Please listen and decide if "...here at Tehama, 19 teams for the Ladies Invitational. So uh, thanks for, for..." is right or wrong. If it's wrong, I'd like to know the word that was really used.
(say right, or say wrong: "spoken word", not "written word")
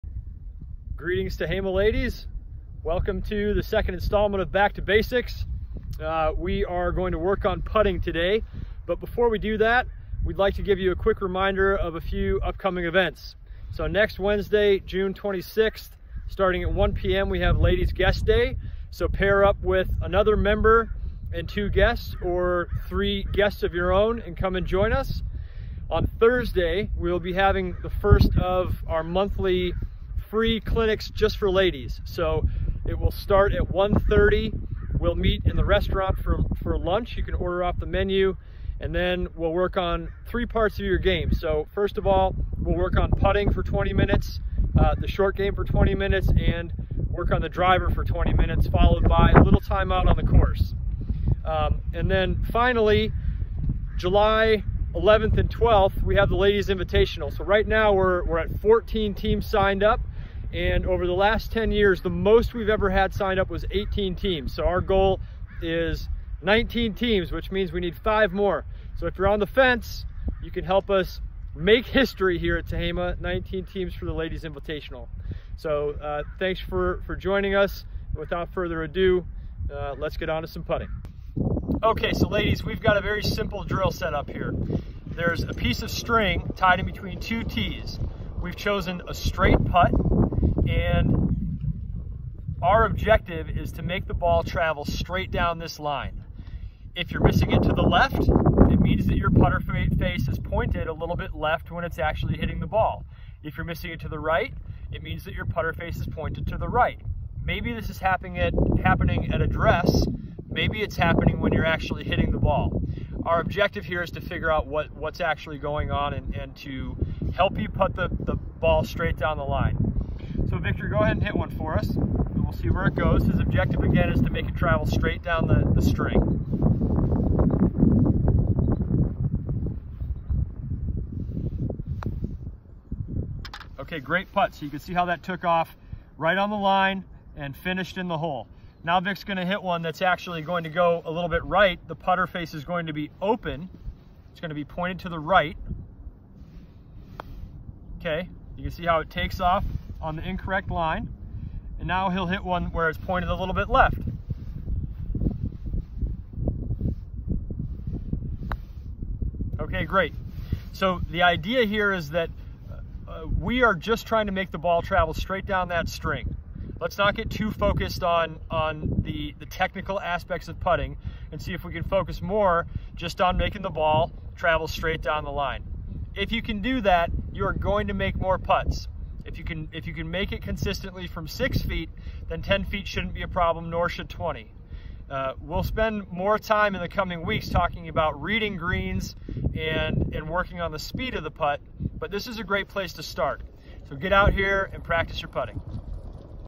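right.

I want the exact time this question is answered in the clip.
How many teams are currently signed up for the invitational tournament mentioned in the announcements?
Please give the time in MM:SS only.
00:58.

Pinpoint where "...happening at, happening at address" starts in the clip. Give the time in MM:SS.
01:47.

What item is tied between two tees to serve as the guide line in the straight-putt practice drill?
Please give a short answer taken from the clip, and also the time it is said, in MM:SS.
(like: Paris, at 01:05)
A piece of string, at 01:25.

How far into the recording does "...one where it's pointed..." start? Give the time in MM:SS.
02:32.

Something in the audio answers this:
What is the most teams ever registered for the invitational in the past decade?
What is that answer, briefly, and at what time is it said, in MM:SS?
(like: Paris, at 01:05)
18, at 01:03.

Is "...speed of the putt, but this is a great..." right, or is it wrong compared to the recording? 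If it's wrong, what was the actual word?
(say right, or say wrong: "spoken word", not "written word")
right.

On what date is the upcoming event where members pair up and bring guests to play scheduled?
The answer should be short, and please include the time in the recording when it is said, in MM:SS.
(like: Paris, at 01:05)
June 26th, at 00:14.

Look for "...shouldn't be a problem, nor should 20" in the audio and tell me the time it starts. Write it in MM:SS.
03:02.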